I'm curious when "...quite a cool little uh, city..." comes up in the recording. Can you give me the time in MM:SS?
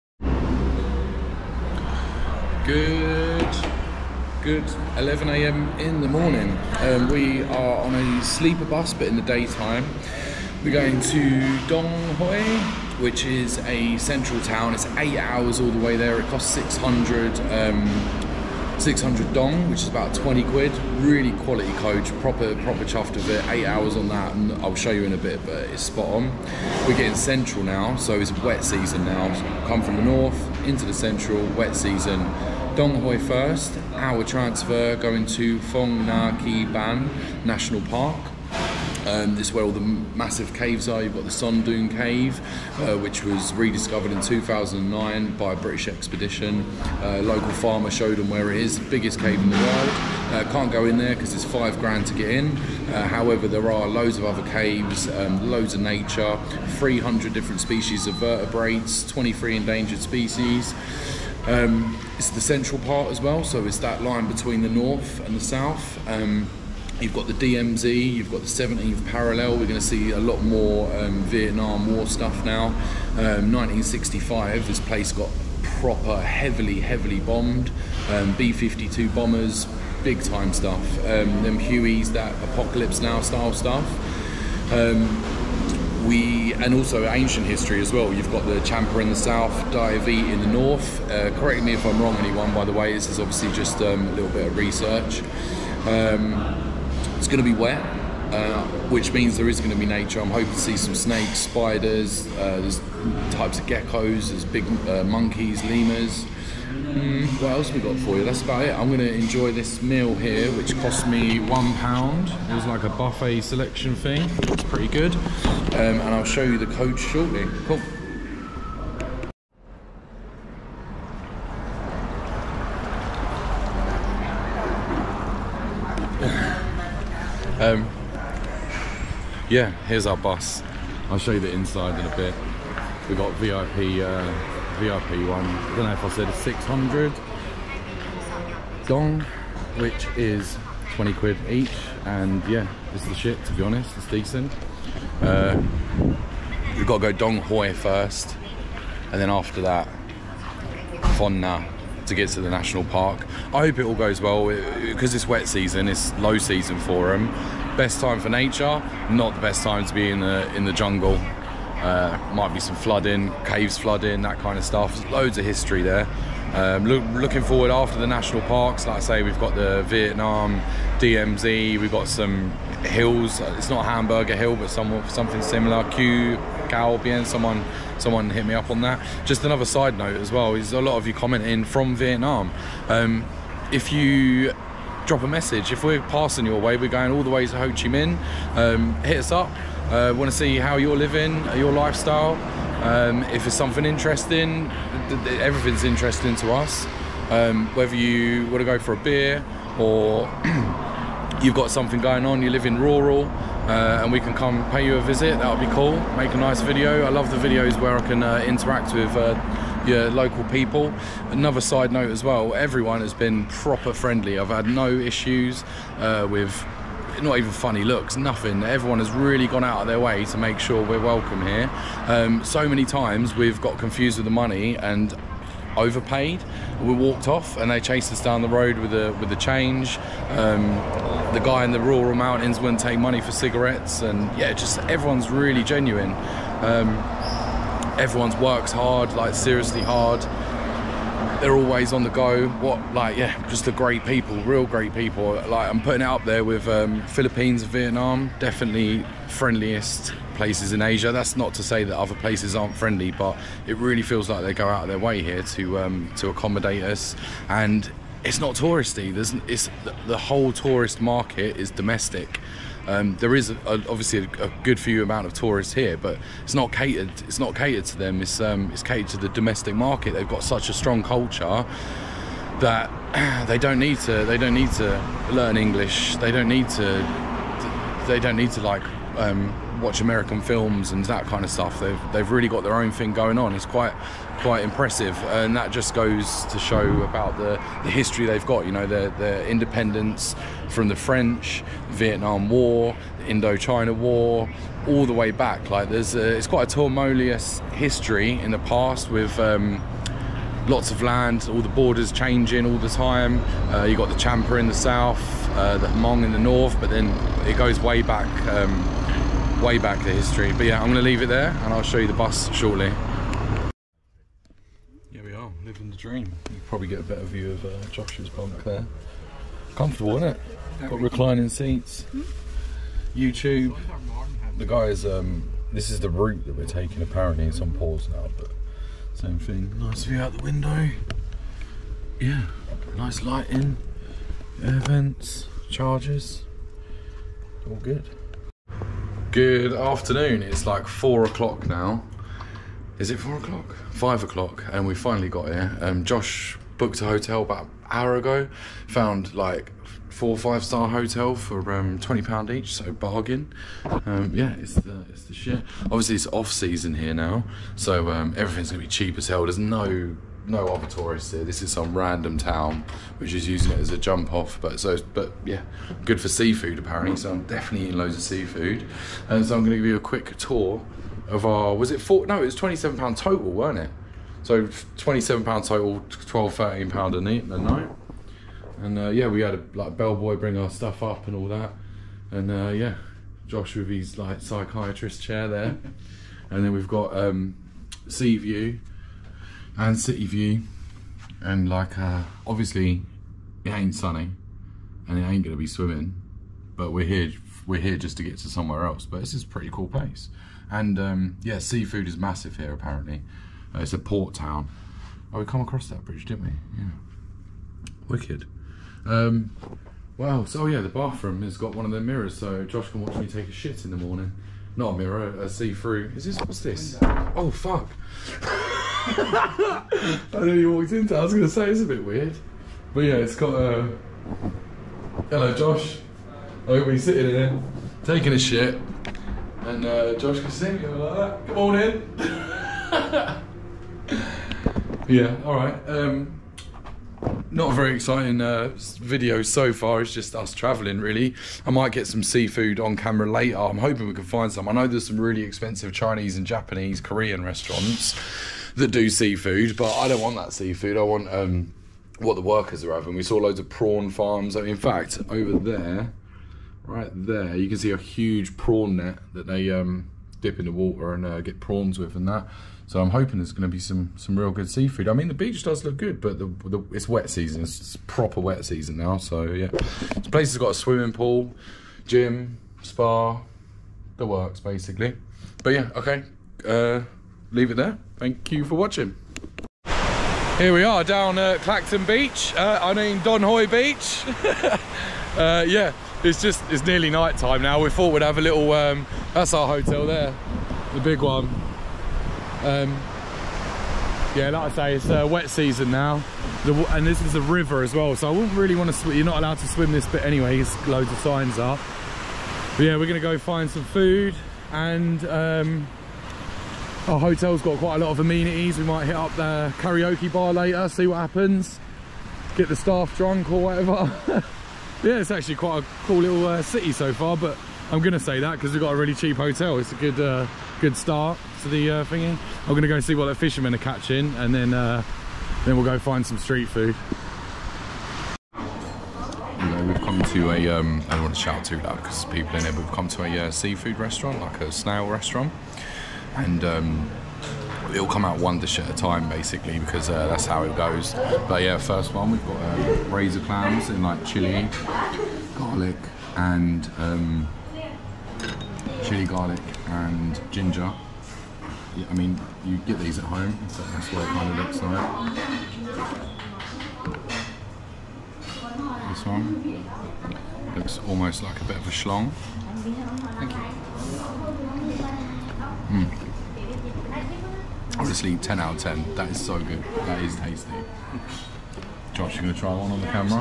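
08:35.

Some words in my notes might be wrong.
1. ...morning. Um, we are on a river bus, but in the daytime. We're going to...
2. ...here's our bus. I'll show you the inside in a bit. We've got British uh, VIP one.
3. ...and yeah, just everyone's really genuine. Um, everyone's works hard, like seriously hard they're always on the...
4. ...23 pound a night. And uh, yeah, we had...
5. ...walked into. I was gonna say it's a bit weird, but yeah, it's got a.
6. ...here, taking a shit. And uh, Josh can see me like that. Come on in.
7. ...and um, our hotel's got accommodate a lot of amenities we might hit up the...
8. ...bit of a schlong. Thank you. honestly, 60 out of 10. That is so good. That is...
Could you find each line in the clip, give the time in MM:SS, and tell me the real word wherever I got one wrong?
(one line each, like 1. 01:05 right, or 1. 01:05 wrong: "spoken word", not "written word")
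1. 00:06 wrong: "sleeper", not "river"
2. 02:09 wrong: "VIP", not "British"
3. 03:54 right
4. 06:16 wrong: "13", not "23"
5. 07:00 right
6. 07:07 right
7. 08:24 wrong: "quite", not "accommodate"
8. 09:21 wrong: "10", not "60".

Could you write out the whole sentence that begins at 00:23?
Eight hours on that, and I'll show you in a bit, but it's spot on.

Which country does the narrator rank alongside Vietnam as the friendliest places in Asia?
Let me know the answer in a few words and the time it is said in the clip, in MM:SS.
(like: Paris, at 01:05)
Philippines, at 04:07.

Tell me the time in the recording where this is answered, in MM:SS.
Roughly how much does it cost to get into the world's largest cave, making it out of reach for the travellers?
00:51.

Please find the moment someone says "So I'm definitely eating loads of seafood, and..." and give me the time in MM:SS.
06:07.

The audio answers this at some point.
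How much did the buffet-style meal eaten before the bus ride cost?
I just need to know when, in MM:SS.
01:51.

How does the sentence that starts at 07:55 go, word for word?
But yeah, okay, uh, leave it there.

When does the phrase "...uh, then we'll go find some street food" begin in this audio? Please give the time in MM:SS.
08:44.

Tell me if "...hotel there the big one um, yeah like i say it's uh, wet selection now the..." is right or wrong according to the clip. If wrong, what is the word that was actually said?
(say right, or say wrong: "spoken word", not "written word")
wrong: "season", not "selection".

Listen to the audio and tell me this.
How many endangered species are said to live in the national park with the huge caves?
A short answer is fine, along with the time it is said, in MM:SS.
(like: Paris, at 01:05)
23, at 00:59.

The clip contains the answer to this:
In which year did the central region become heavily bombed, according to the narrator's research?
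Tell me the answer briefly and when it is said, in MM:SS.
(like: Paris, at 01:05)
1965, at 01:13.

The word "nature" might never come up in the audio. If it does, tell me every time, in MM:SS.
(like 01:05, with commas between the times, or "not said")
00:55, 01:39, 02:38.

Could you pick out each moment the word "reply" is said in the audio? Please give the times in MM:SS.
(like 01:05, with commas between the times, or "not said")
not said.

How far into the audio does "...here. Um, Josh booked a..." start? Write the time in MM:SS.
05:45.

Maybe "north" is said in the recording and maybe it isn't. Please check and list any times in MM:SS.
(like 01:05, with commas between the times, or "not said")
00:30, 01:04, 01:30, 05:06.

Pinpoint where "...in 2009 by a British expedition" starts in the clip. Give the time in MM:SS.
00:44.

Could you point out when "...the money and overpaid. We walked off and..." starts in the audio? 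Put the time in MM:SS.
03:44.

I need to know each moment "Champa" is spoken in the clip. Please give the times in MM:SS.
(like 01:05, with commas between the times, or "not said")
01:28, 05:04.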